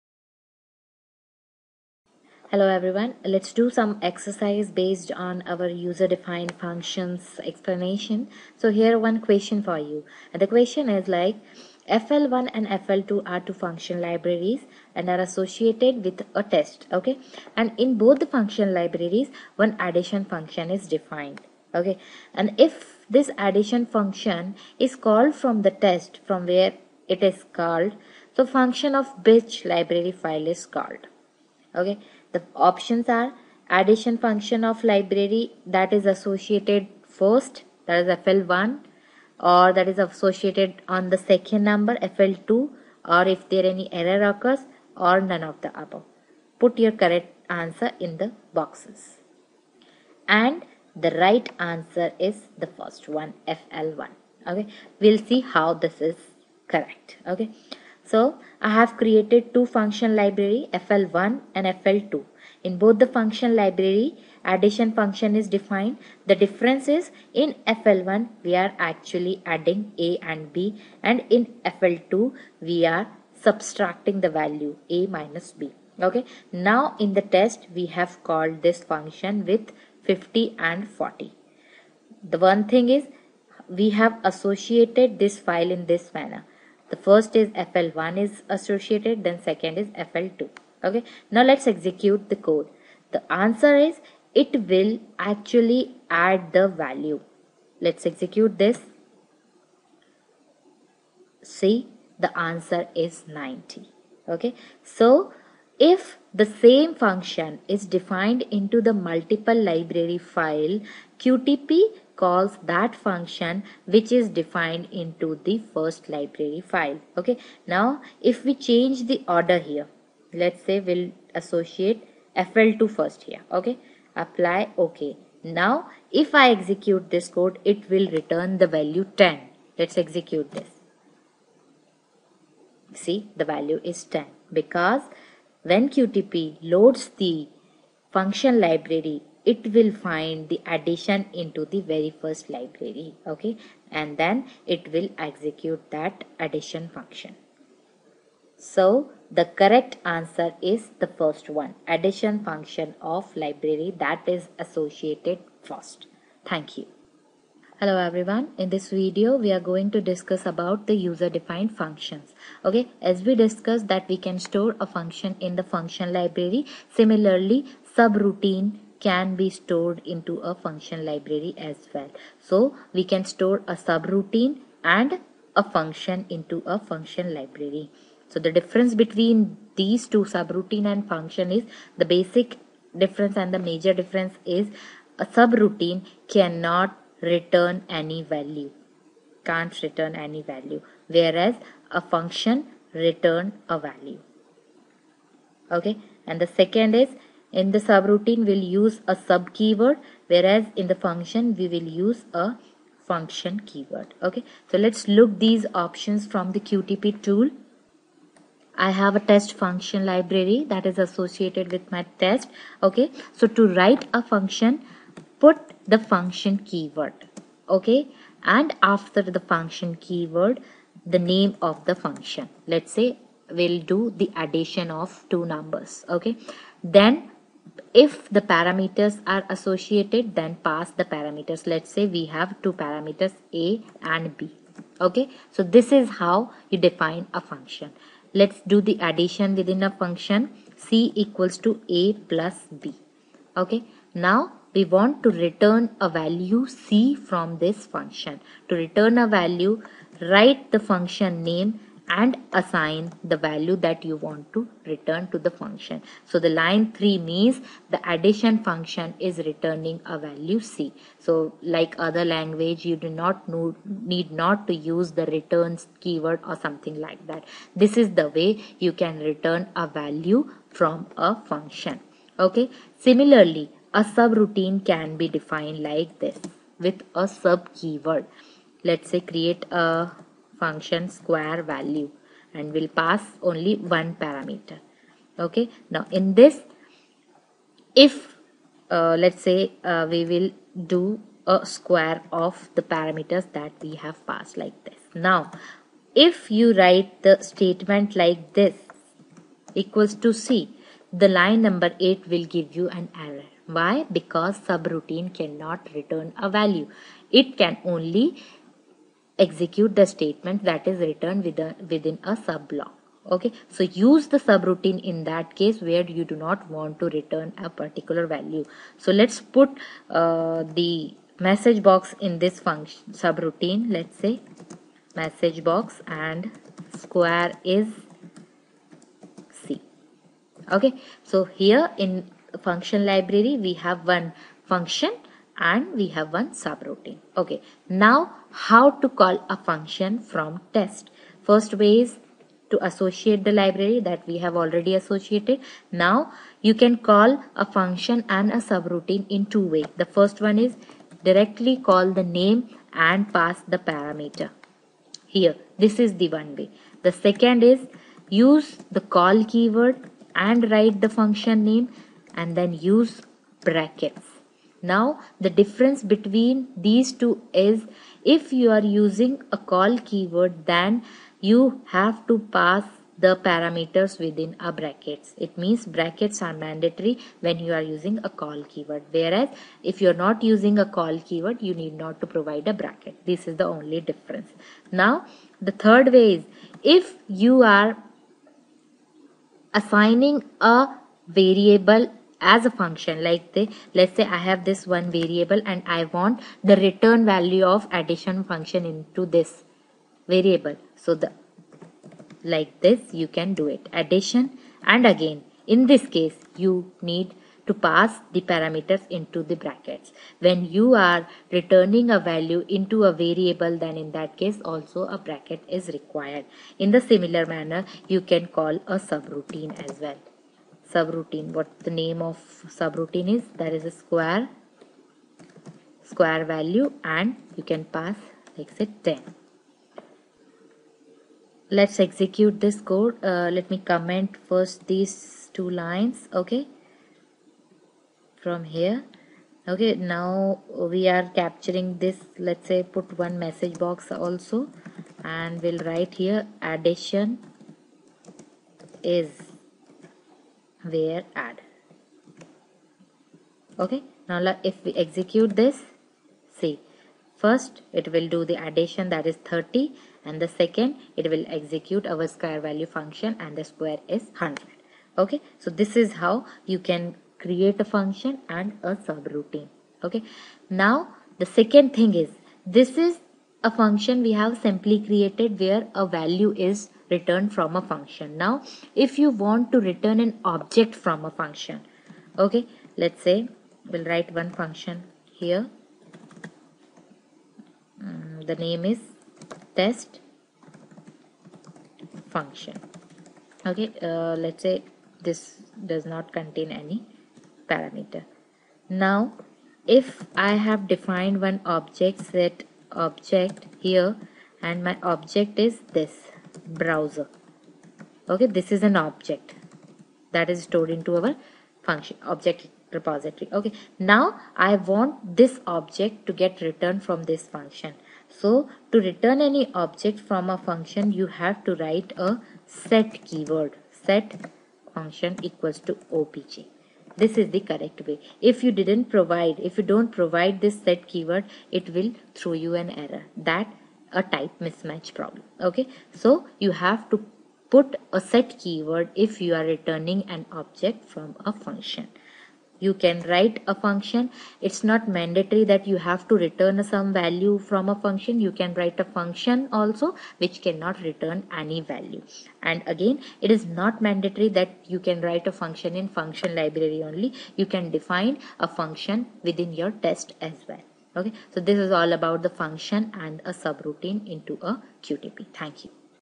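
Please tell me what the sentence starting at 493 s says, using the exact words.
Okay, uh, let's say this does not contain any parameter.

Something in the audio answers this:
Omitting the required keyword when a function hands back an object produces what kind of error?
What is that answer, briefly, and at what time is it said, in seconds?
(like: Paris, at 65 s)
type mismatch, at 534 s.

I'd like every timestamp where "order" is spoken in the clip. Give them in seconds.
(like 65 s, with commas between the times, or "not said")
119 s.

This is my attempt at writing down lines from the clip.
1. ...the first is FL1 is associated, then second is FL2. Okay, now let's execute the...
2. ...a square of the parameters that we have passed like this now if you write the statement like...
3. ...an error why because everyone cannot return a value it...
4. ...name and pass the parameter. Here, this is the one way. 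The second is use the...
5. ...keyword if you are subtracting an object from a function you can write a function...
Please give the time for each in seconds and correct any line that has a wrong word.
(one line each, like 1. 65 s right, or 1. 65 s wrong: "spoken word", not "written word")
1. 86 s right
2. 291 s right
3. 302 s wrong: "subroutine", not "everyone"
4. 352 s right
5. 538 s wrong: "returning", not "subtracting".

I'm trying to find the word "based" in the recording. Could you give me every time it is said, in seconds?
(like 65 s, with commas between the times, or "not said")
4 s.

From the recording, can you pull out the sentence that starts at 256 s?
So the line 3 means the addition function is returning a value C.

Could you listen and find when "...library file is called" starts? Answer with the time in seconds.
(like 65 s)
29 s.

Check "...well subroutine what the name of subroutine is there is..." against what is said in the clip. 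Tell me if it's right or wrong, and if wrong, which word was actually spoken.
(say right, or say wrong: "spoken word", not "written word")
right.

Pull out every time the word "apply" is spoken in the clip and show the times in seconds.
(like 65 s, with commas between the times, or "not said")
124 s.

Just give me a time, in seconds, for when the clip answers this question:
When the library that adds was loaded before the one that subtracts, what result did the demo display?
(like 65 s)
103 s.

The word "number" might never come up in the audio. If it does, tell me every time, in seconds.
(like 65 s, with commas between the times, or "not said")
41 s, 225 s, 301 s.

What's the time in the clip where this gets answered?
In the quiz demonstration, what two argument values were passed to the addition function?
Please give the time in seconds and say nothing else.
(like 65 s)
80 s.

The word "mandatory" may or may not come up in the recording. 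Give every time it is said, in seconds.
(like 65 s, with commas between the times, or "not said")
376 s, 545 s, 554 s.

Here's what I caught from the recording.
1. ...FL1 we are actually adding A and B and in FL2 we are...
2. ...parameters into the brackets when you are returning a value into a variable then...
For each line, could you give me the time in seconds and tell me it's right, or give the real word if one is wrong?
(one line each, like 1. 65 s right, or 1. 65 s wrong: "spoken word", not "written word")
1. 67 s right
2. 408 s right.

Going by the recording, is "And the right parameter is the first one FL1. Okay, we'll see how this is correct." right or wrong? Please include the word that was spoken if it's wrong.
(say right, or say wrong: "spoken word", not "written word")
wrong: "answer", not "parameter".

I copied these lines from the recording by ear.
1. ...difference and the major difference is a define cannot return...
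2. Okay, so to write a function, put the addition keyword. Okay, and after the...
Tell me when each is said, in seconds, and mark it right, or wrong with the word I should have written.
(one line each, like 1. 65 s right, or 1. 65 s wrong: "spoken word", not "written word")
1. 182 s wrong: "subroutine", not "define"
2. 212 s wrong: "function", not "addition".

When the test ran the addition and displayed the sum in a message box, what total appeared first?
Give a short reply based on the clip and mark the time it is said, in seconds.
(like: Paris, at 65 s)
30, at 459 s.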